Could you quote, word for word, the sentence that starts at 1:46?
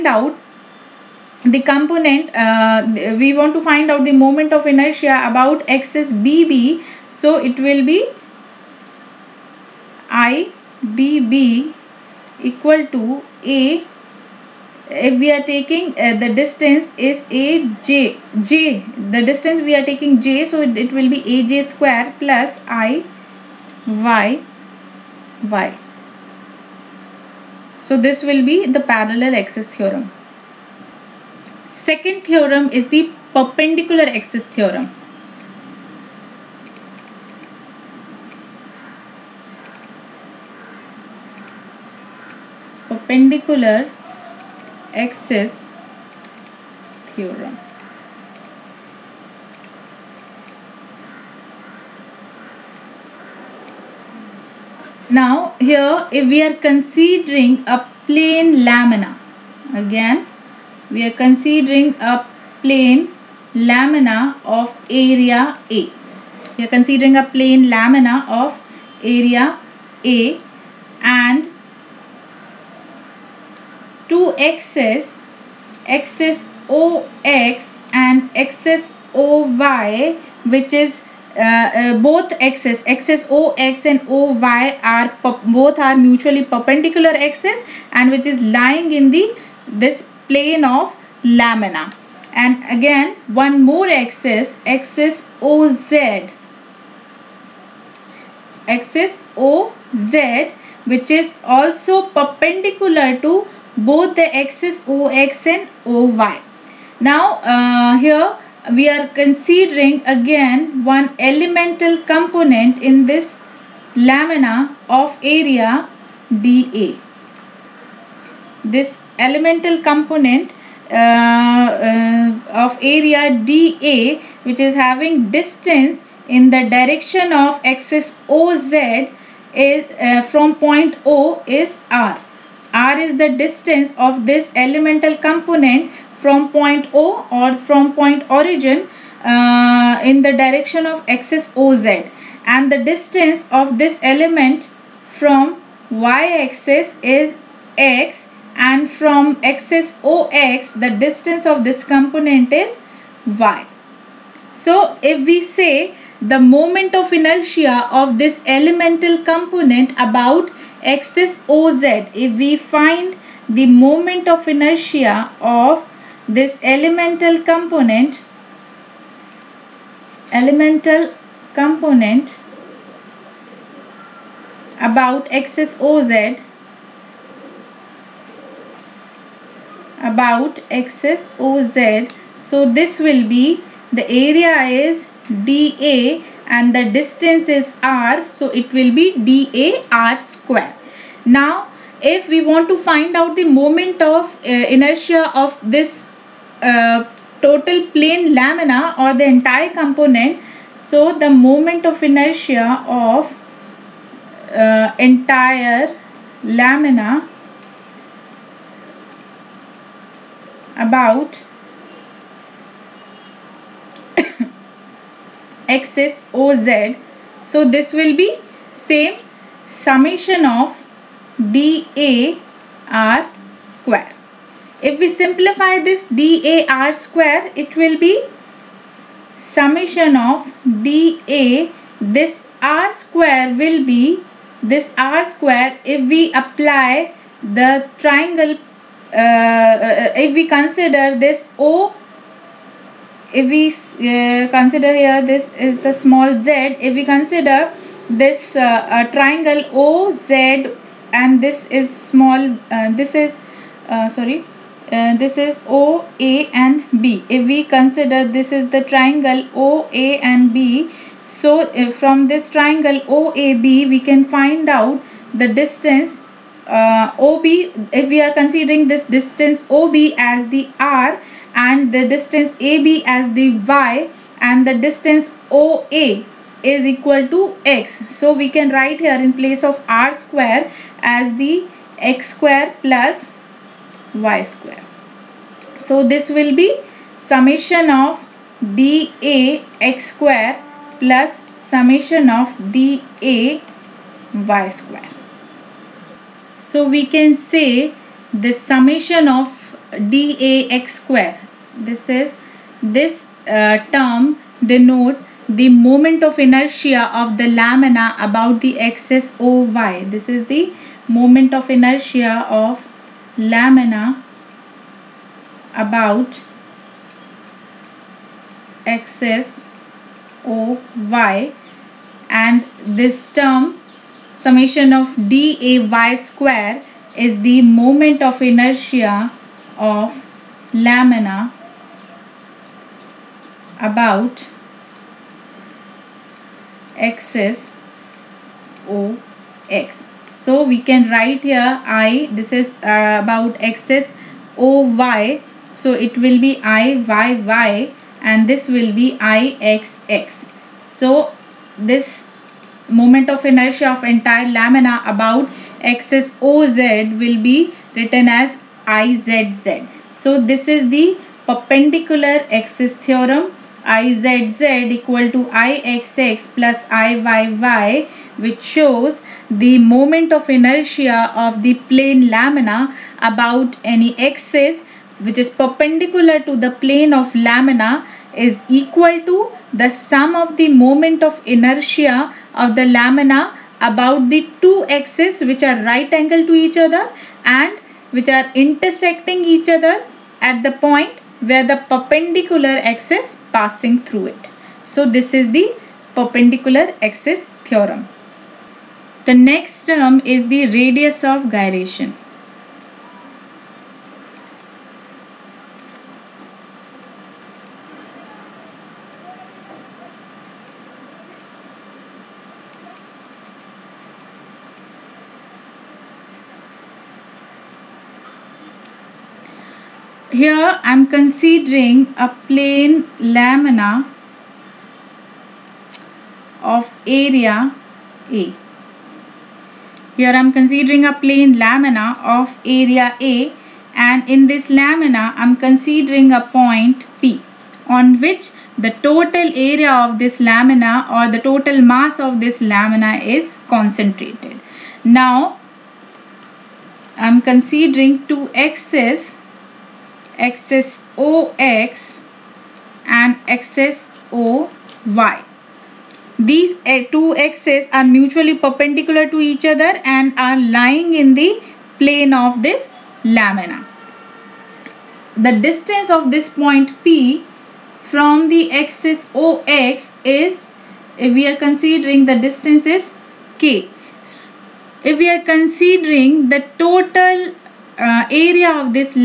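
Now uh, here we are considering again one elemental component in this lamina of area DA.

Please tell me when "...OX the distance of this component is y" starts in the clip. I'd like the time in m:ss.
2:30.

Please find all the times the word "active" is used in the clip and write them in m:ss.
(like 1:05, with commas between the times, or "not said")
not said.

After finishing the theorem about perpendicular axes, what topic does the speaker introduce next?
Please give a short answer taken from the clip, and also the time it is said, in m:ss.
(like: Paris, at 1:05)
Radius of gyration, at 6:40.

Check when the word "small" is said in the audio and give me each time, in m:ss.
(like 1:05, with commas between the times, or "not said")
4:05, 4:12.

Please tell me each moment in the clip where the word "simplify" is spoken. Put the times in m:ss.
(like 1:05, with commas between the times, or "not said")
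3:45.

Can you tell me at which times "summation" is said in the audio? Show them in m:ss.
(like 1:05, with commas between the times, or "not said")
3:39, 3:49, 4:47, 4:51, 4:58, 5:24.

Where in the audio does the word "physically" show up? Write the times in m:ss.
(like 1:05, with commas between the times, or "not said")
not said.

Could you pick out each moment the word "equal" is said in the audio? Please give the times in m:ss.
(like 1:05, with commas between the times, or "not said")
0:12, 4:36, 6:04, 6:18.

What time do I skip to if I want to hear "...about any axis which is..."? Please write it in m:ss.
6:13.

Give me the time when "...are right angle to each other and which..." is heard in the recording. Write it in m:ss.
6:25.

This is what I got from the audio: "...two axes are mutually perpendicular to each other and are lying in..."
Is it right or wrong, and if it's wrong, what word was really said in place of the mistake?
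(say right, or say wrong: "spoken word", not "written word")
right.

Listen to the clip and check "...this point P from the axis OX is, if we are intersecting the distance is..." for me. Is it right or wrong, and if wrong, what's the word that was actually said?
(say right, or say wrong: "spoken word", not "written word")
wrong: "considering", not "intersecting".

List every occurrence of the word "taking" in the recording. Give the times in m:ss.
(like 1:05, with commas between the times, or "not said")
0:15, 0:19.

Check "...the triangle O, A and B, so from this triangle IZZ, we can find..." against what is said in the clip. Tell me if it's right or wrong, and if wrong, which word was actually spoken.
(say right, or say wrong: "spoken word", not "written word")
wrong: "OAB", not "IZZ".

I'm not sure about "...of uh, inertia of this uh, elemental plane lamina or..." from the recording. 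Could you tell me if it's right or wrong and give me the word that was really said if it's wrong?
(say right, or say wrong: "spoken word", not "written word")
wrong: "total", not "elemental".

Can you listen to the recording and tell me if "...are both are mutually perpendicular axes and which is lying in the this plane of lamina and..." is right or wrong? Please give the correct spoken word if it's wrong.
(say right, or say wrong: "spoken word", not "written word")
right.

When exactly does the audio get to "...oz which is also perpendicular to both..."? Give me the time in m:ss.
1:39.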